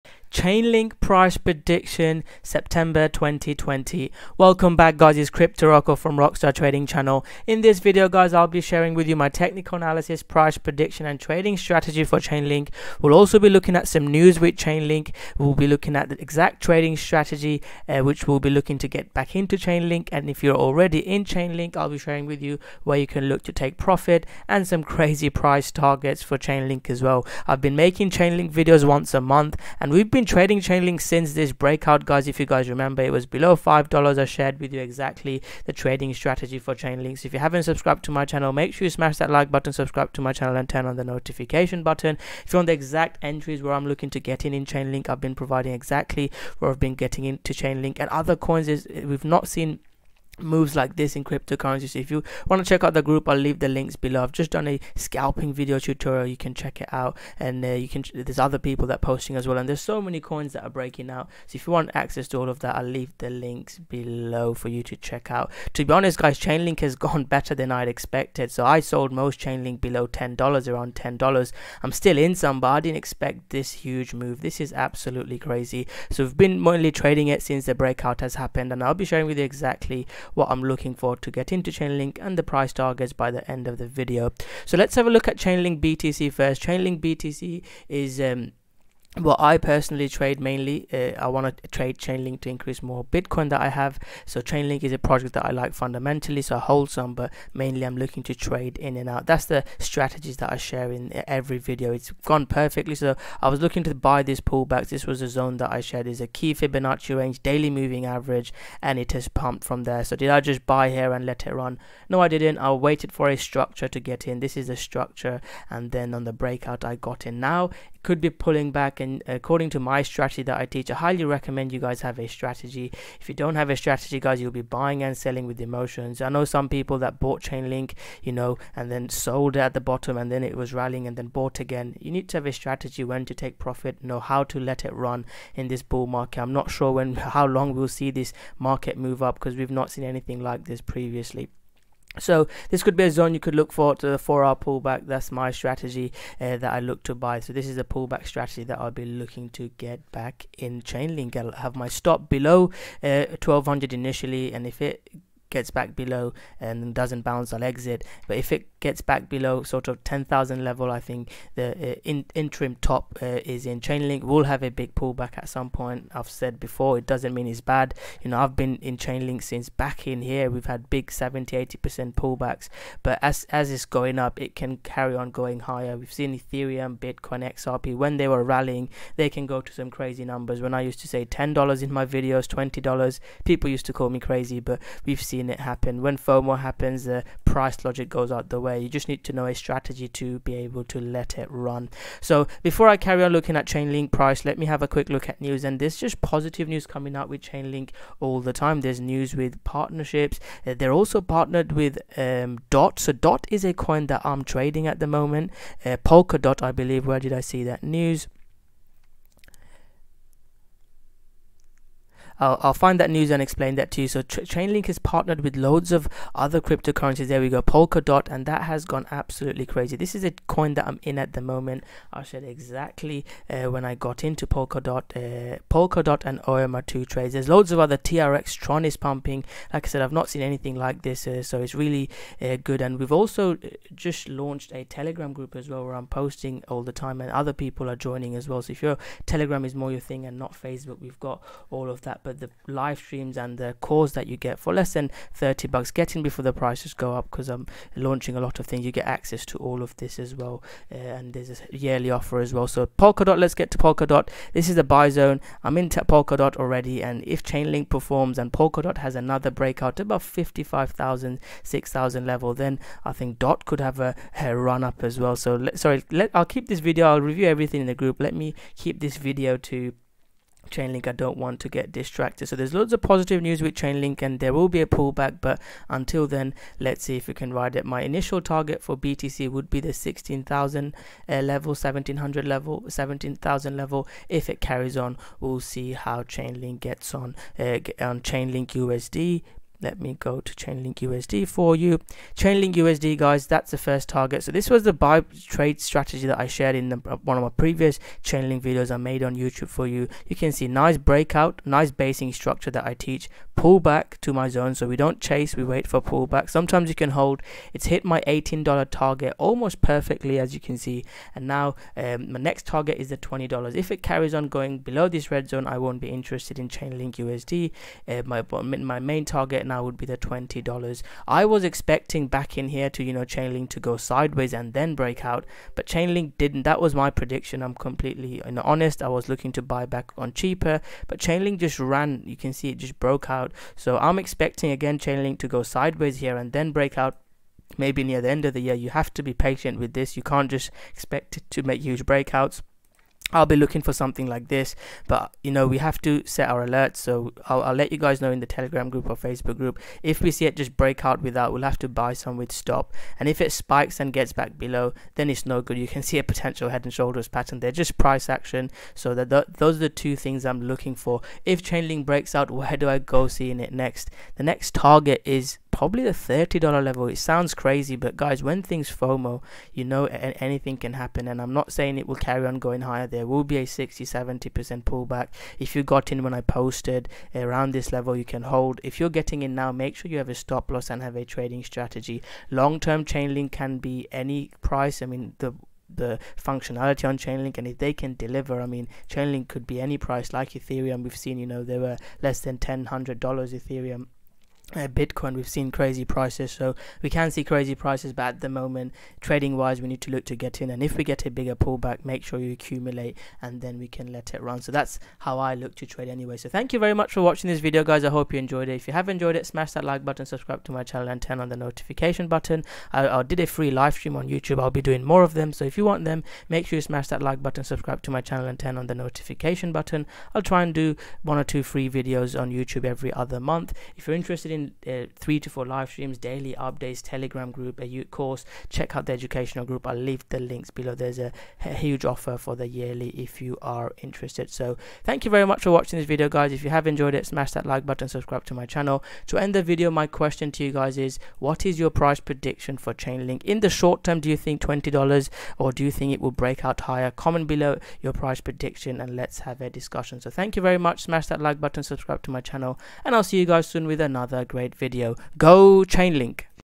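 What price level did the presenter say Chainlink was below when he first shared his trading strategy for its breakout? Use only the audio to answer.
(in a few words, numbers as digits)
$5.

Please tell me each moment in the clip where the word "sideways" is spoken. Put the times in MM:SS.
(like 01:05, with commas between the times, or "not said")
05:23, 05:35.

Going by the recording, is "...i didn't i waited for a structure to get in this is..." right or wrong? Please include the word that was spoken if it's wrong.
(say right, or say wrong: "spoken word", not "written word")
right.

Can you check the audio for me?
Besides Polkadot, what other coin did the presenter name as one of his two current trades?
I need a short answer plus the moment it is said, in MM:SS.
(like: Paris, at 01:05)
OM, at 03:46.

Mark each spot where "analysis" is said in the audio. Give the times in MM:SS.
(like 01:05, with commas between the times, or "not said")
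00:09.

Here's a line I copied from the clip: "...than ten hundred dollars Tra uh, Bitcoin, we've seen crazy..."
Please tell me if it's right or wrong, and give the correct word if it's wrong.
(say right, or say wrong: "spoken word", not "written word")
wrong: "Ethereum", not "Tra".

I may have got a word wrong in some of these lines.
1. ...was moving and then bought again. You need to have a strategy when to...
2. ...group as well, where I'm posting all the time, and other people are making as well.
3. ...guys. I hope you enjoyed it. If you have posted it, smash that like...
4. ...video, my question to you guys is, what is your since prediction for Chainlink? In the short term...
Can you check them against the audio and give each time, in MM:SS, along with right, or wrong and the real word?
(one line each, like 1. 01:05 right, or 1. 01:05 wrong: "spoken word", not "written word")
1. 02:10 wrong: "rallying", not "moving"
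2. 03:55 wrong: "joining", not "making"
3. 06:47 wrong: "enjoyed", not "posted"
4. 07:19 wrong: "price", not "since".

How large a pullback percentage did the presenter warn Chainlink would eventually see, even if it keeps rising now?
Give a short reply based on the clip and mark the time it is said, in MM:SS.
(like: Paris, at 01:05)
60-70%, at 06:13.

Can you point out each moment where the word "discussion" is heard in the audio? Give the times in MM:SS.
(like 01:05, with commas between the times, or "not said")
07:29.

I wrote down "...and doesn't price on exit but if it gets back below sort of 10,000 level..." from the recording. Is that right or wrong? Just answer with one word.
wrong.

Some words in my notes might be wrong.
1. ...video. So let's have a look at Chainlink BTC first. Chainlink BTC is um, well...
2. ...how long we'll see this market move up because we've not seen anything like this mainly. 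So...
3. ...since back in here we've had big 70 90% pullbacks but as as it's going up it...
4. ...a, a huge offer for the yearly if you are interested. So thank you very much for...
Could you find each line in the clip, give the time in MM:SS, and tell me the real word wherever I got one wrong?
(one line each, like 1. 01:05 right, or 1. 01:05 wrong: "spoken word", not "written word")
1. 01:23 right
2. 02:17 wrong: "previously", not "mainly"
3. 02:49 wrong: "80", not "90"
4. 07:11 right.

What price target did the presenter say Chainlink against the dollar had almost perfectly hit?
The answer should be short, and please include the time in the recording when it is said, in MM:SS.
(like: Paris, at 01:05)
$18, at 05:08.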